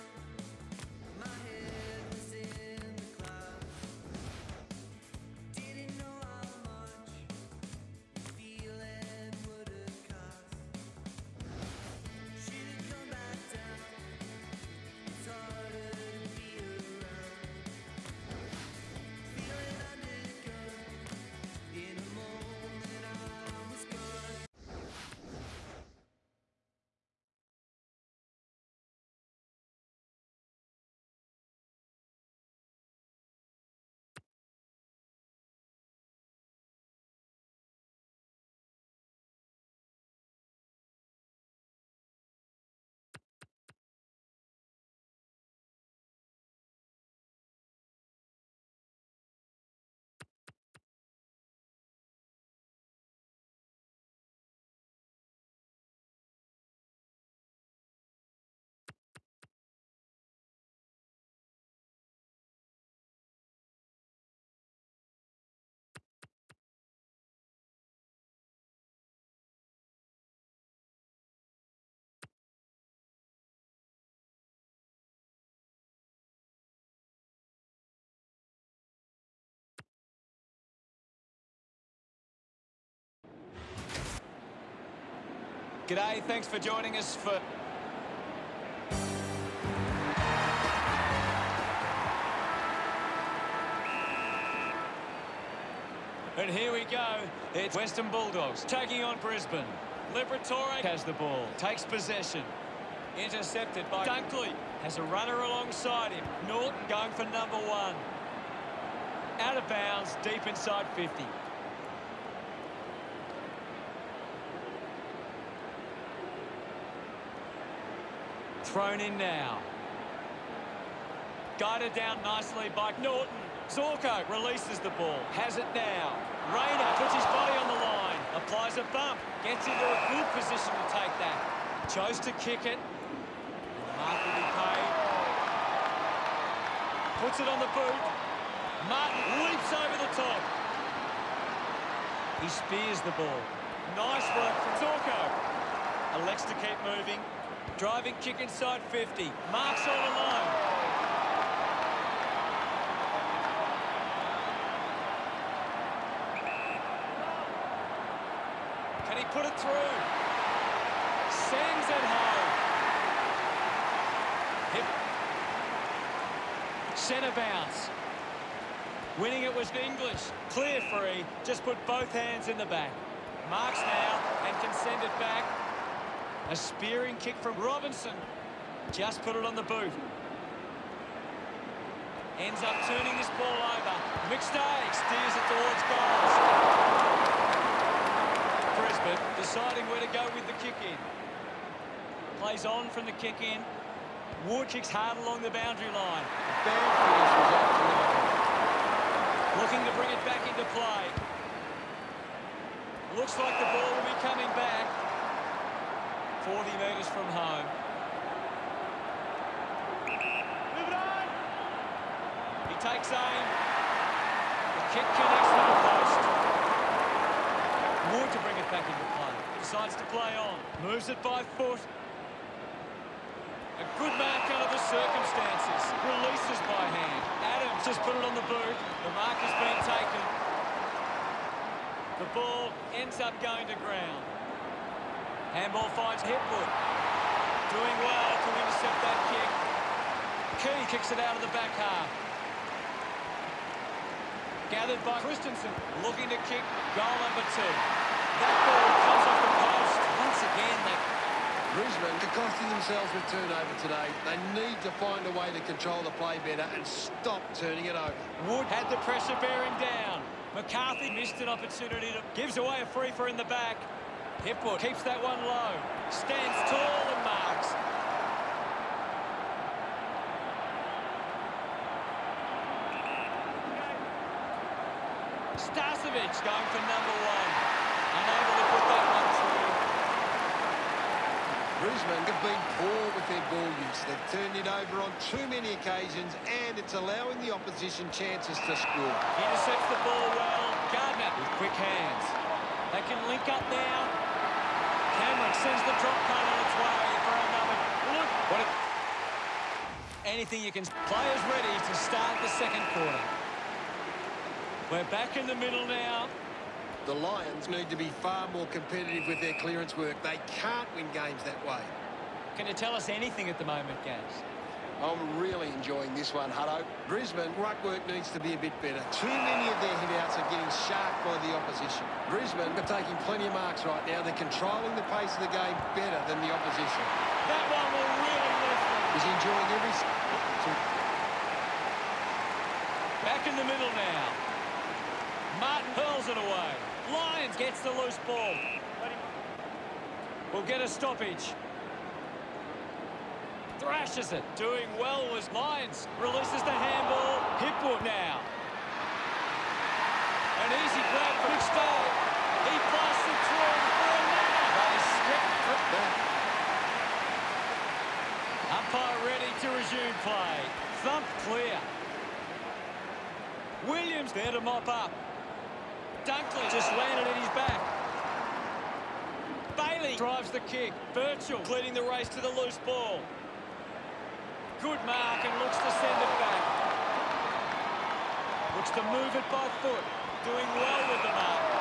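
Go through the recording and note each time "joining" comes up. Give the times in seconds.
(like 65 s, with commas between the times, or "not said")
86 s.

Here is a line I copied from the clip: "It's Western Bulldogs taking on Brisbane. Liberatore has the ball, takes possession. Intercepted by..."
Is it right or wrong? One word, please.
right.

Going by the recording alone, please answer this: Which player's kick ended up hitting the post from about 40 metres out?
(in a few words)
Moore.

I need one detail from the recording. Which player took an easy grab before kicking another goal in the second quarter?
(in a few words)
Stoll.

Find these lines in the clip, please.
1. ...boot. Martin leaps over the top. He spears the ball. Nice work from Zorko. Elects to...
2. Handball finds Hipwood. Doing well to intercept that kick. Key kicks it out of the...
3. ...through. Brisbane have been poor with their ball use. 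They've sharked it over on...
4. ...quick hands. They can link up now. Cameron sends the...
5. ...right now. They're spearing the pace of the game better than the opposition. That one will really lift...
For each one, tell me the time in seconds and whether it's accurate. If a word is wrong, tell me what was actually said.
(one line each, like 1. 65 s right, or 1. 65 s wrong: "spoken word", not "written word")
1. 137 s right
2. 235 s right
3. 279 s wrong: "turned", not "sharked"
4. 291 s right
5. 323 s wrong: "controlling", not "spearing".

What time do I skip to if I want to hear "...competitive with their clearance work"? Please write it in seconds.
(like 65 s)
308 s.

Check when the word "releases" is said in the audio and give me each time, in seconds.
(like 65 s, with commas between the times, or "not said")
124 s, 226 s, 346 s.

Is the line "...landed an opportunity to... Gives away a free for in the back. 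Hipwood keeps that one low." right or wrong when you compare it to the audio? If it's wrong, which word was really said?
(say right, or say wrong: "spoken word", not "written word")
wrong: "missed", not "landed".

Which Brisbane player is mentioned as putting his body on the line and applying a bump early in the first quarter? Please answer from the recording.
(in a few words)
Rayner.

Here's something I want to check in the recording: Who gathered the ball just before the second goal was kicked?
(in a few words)
Christensen.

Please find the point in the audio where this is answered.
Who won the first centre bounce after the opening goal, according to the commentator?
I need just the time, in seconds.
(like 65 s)
169 s.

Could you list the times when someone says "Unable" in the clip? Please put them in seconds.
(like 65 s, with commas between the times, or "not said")
278 s.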